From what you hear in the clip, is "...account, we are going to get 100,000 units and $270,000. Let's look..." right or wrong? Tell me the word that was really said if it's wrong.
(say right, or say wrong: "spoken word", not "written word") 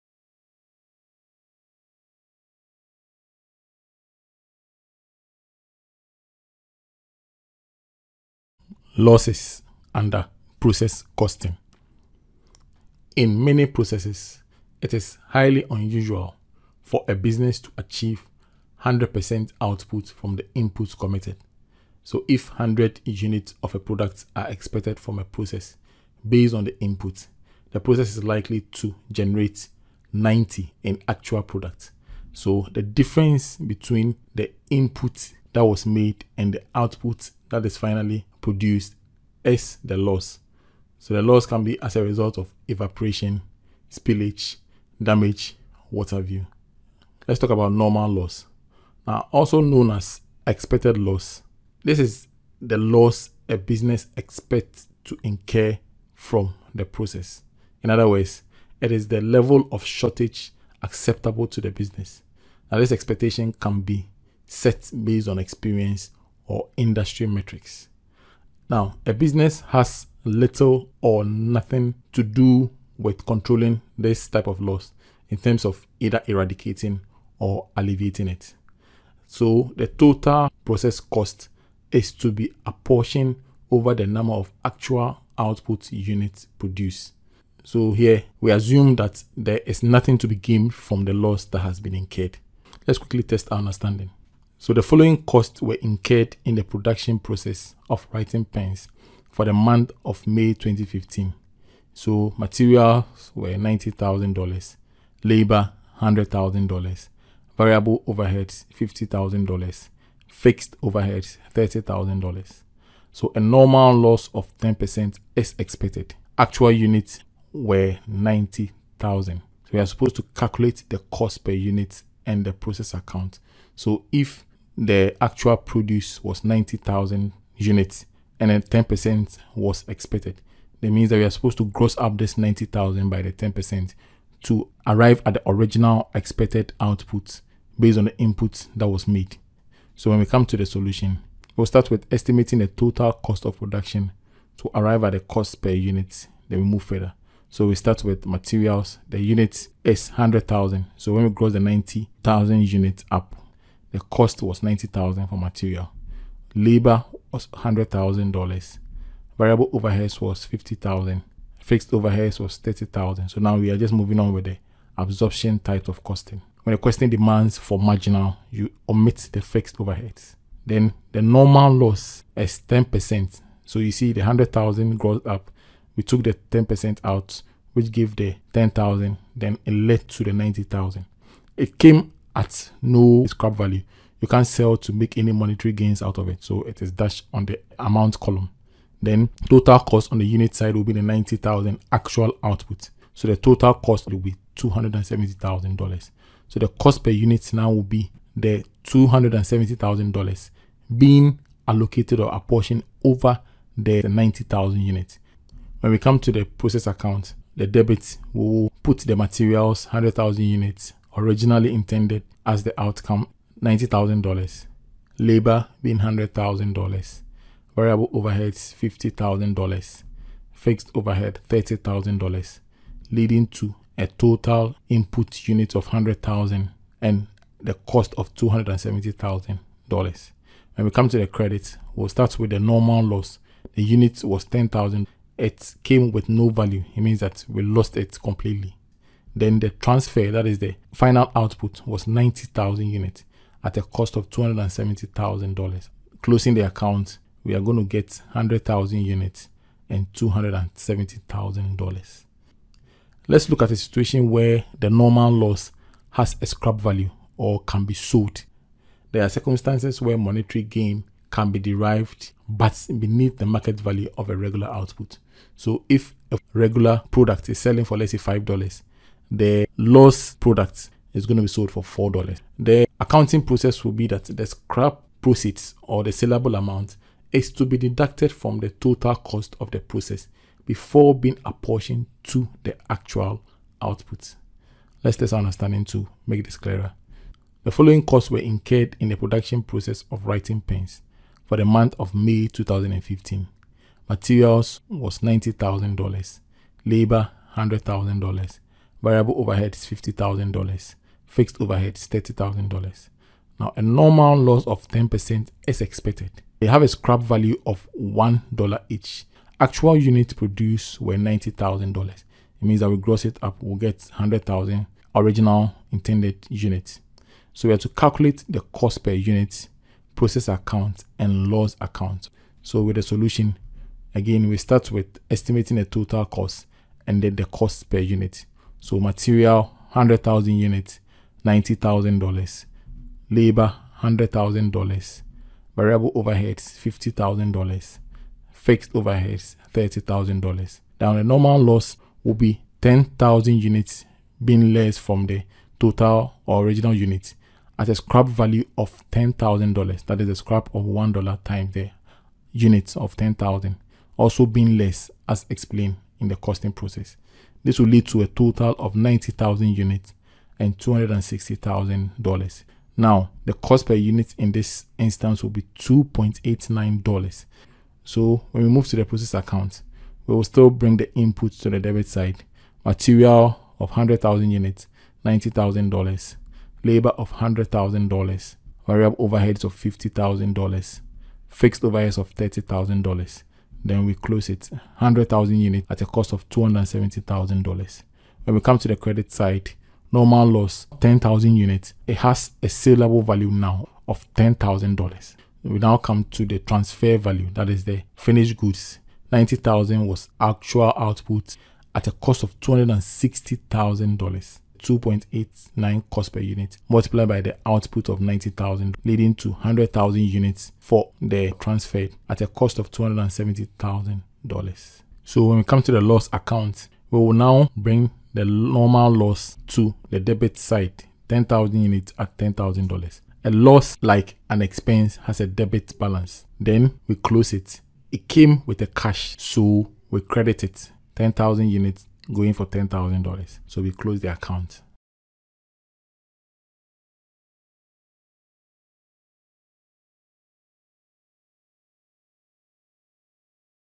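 right.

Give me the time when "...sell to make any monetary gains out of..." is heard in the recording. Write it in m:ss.
3:04.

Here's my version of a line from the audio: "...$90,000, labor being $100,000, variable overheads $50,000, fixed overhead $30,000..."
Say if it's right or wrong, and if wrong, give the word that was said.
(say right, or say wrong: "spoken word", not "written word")
right.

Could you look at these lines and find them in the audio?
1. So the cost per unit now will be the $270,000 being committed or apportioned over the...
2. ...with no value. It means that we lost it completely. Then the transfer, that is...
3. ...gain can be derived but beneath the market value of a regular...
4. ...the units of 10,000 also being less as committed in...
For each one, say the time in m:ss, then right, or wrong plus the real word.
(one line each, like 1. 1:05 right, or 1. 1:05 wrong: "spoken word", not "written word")
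1. 3:16 wrong: "allocated", not "committed"
2. 3:56 right
3. 4:20 right
4. 5:51 wrong: "explained", not "committed".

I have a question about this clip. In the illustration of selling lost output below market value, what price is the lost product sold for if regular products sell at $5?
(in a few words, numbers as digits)
$4.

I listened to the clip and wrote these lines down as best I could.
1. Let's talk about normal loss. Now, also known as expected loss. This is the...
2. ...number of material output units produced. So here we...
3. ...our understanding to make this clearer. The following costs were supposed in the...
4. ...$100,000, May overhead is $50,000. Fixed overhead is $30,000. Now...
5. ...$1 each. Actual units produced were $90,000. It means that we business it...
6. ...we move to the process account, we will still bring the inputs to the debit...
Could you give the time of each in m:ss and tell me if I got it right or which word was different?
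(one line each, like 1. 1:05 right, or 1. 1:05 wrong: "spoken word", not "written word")
1. 0:47 right
2. 1:24 wrong: "actual", not "material"
3. 4:45 wrong: "incurred", not "supposed"
4. 4:57 wrong: "Variable", not "May"
5. 5:07 wrong: "gross", not "business"
6. 6:08 right.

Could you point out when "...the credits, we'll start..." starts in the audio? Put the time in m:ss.
3:51.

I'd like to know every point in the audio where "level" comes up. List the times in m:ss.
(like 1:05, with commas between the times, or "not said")
0:59.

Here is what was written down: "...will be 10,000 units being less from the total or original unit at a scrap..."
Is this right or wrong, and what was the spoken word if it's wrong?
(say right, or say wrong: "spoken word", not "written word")
right.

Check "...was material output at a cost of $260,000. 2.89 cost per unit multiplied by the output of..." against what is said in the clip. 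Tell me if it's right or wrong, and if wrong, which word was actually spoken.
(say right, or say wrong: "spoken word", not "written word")
wrong: "actual", not "material".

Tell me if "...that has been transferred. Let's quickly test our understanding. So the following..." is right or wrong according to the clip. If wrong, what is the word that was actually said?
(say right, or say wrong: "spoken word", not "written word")
wrong: "incurred", not "transferred".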